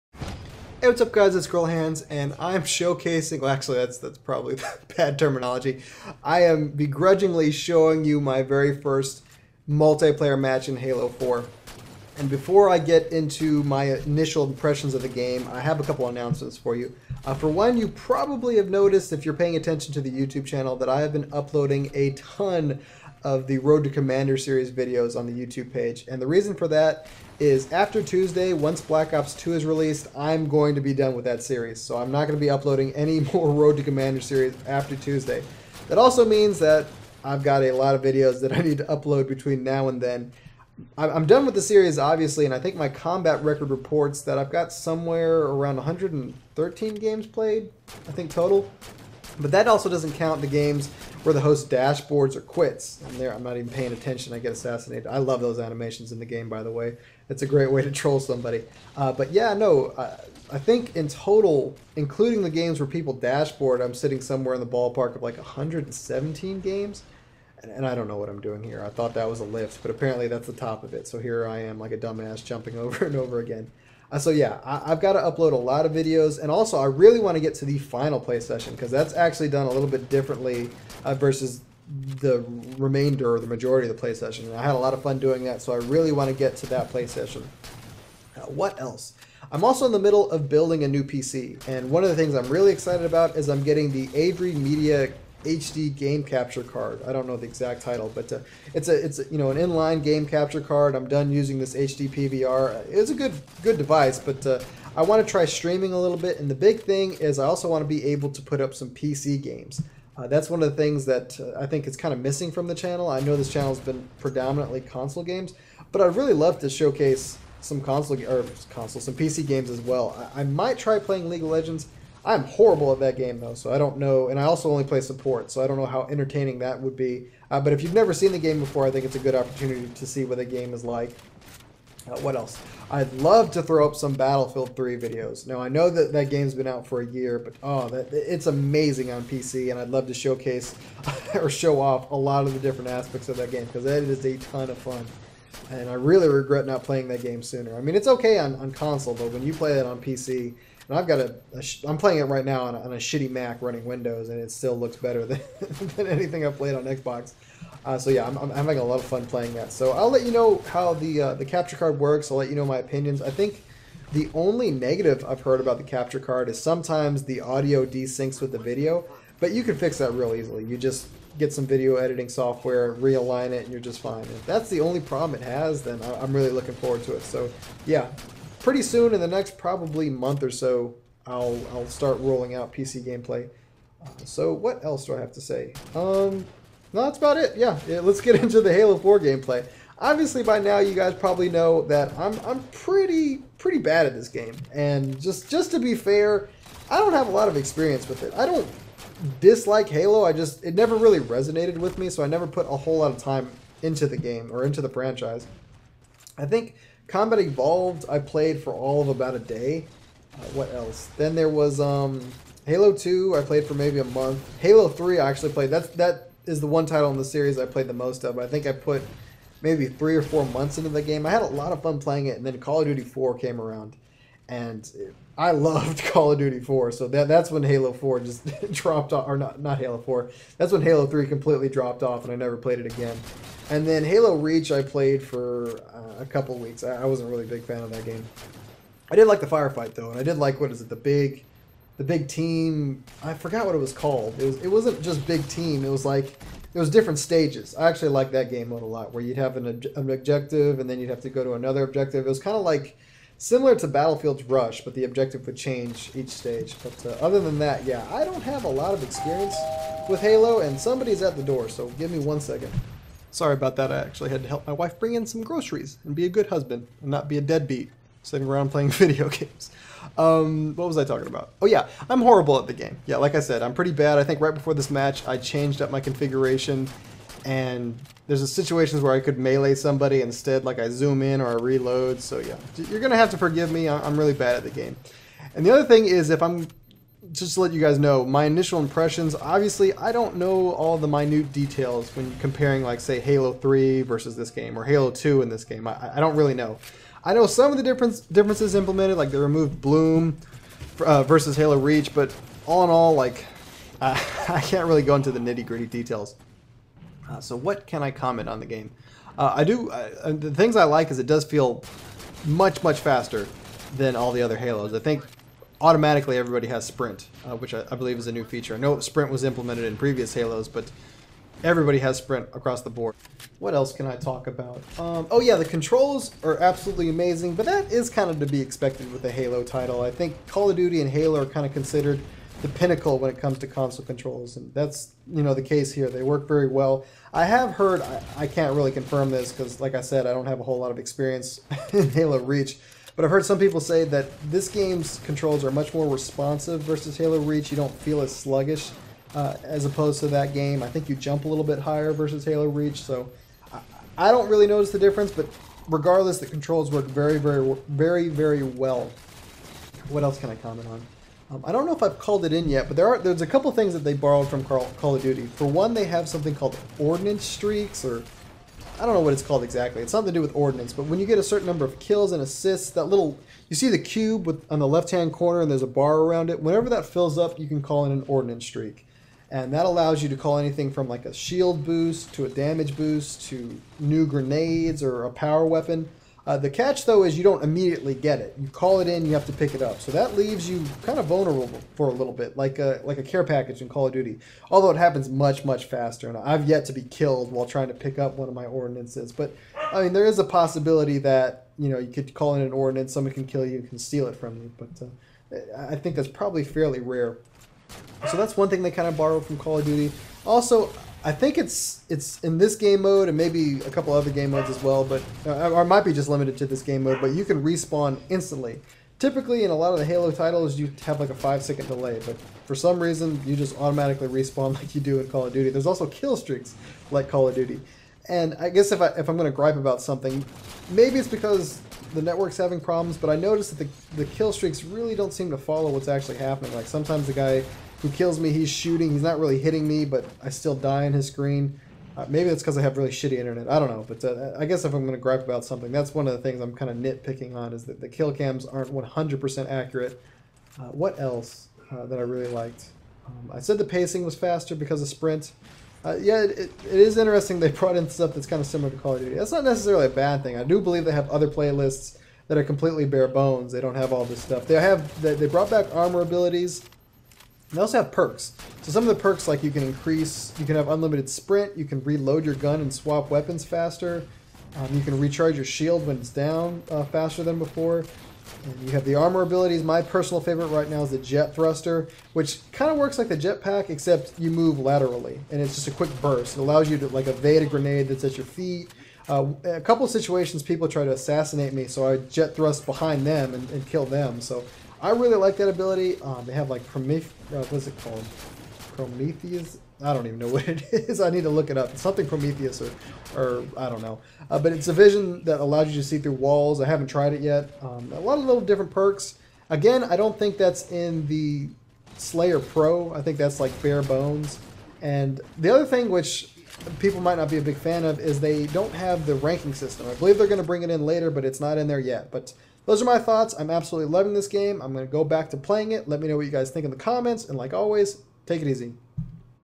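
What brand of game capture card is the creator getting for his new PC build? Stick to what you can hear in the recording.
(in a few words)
AVerMedia.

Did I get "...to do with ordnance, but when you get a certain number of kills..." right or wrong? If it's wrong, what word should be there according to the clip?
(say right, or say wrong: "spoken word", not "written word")
right.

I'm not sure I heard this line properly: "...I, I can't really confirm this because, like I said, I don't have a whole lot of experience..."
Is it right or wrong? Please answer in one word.
right.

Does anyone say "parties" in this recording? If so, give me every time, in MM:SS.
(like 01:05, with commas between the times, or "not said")
not said.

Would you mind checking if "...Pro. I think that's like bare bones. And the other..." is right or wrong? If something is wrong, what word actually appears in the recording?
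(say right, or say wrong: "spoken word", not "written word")
right.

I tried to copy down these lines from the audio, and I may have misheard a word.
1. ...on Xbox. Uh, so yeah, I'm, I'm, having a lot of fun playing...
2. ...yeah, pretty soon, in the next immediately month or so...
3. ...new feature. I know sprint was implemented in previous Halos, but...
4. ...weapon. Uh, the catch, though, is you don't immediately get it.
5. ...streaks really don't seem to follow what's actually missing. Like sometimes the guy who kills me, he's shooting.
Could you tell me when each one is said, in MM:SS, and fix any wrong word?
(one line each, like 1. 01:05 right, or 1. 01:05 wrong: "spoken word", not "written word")
1. 02:36 right
2. 02:57 wrong: "probably", not "immediately"
3. 05:18 right
4. 06:25 right
5. 07:14 wrong: "happening", not "missing".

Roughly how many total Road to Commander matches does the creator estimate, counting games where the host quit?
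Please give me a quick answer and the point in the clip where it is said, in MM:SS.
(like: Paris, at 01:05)
117, at 01:05.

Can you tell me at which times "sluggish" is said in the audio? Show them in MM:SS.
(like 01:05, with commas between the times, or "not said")
05:48.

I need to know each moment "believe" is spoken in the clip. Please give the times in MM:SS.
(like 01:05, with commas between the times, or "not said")
05:17, 07:40, 08:40.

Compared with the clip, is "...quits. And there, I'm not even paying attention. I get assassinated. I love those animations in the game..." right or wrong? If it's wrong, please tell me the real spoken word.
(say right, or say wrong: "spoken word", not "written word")
right.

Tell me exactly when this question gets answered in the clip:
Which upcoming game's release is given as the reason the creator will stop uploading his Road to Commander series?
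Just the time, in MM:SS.
00:28.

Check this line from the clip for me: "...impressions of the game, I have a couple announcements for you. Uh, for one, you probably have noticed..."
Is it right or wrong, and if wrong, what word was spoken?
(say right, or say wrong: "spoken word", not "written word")
right.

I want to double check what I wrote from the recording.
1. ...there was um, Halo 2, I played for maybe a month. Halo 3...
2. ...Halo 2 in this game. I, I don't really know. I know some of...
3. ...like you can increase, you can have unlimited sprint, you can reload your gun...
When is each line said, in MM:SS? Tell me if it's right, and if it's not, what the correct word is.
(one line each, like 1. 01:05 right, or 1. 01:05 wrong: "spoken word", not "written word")
1. 03:31 right
2. 04:54 right
3. 07:49 right.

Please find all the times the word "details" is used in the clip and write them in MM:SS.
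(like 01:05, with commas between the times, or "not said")
04:51, 05:05.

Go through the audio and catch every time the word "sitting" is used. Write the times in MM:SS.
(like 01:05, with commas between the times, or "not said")
01:03, 04:28.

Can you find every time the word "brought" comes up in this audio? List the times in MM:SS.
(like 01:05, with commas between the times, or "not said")
07:37, 07:45.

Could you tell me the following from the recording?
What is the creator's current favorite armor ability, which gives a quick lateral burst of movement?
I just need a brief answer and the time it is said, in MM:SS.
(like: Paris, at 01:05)
jet thruster, at 08:01.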